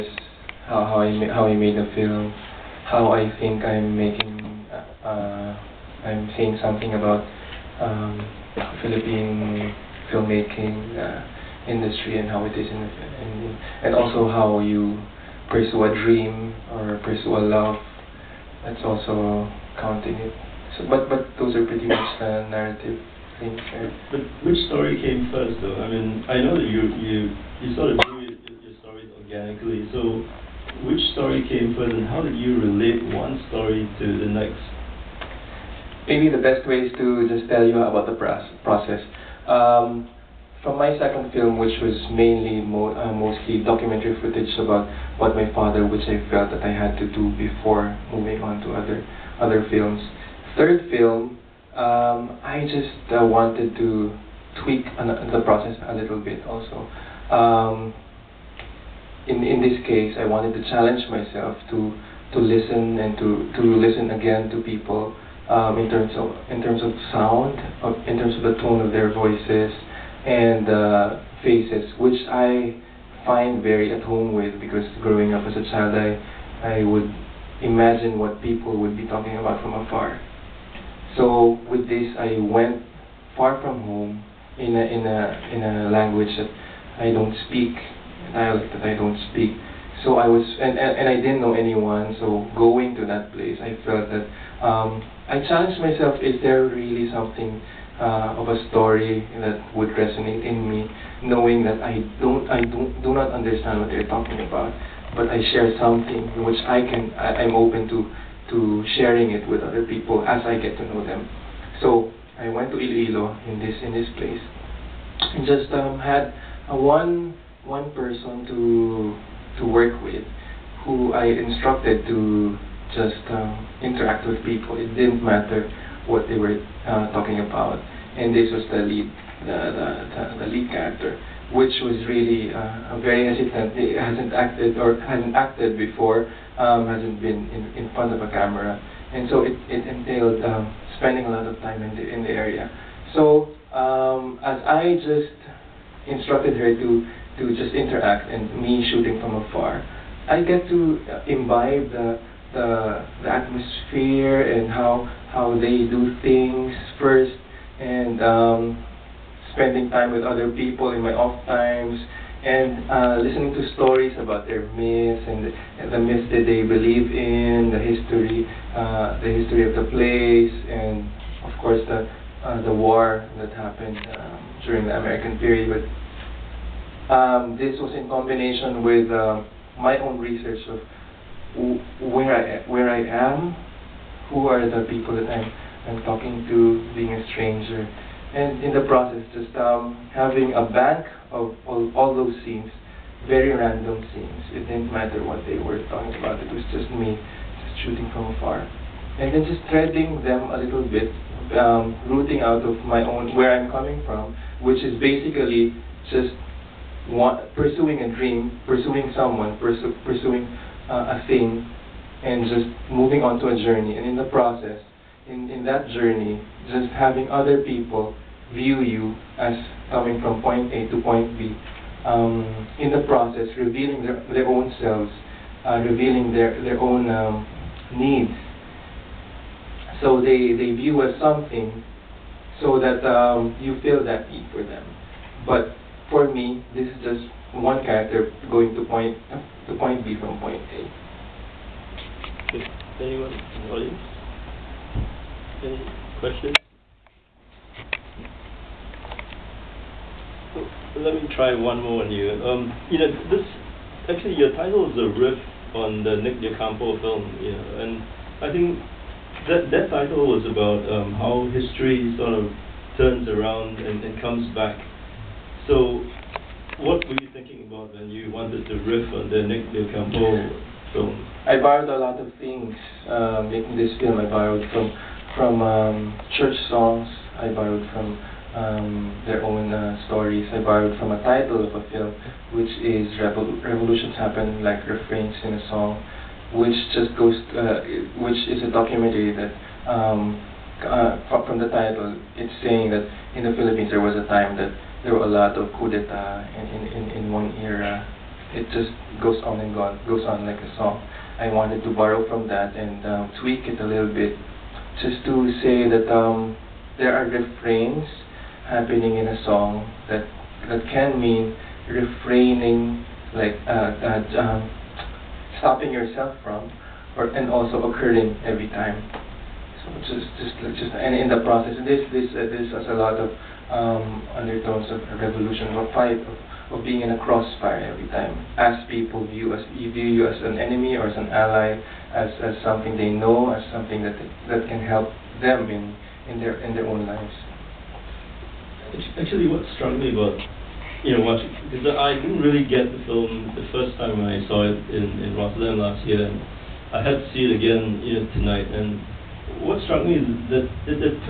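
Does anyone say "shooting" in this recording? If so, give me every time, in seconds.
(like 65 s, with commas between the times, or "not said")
148 s, 197 s.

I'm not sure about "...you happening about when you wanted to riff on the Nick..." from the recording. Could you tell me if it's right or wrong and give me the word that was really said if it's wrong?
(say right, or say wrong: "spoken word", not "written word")
wrong: "thinking", not "happening".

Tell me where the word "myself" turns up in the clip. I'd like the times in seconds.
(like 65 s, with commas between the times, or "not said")
61 s, 95 s.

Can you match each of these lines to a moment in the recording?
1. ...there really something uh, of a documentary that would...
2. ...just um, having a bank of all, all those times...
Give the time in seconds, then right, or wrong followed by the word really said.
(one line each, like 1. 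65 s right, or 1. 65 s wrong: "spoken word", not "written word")
1. 96 s wrong: "story", not "documentary"
2. 189 s wrong: "scenes", not "times".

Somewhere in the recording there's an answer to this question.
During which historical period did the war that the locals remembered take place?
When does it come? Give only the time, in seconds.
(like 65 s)
174 s.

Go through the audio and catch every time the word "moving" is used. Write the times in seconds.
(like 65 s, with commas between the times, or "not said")
48 s, 212 s.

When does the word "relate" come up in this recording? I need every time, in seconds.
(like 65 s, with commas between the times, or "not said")
32 s.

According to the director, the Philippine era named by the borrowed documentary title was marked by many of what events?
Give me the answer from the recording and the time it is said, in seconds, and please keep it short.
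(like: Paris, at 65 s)
coup d'etat, at 295 s.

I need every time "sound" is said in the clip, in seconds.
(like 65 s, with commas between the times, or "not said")
67 s.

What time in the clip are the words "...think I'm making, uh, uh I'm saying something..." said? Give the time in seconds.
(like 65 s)
3 s.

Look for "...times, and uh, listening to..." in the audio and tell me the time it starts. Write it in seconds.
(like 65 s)
161 s.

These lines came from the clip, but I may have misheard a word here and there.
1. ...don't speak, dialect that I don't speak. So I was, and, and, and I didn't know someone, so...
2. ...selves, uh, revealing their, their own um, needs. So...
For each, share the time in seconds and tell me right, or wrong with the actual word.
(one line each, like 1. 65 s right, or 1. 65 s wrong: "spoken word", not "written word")
1. 87 s wrong: "anyone", not "someone"
2. 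224 s right.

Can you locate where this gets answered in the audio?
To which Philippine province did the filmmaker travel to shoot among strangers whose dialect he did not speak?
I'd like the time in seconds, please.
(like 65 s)
112 s.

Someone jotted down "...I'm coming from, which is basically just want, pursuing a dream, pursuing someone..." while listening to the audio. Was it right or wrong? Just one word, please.
right.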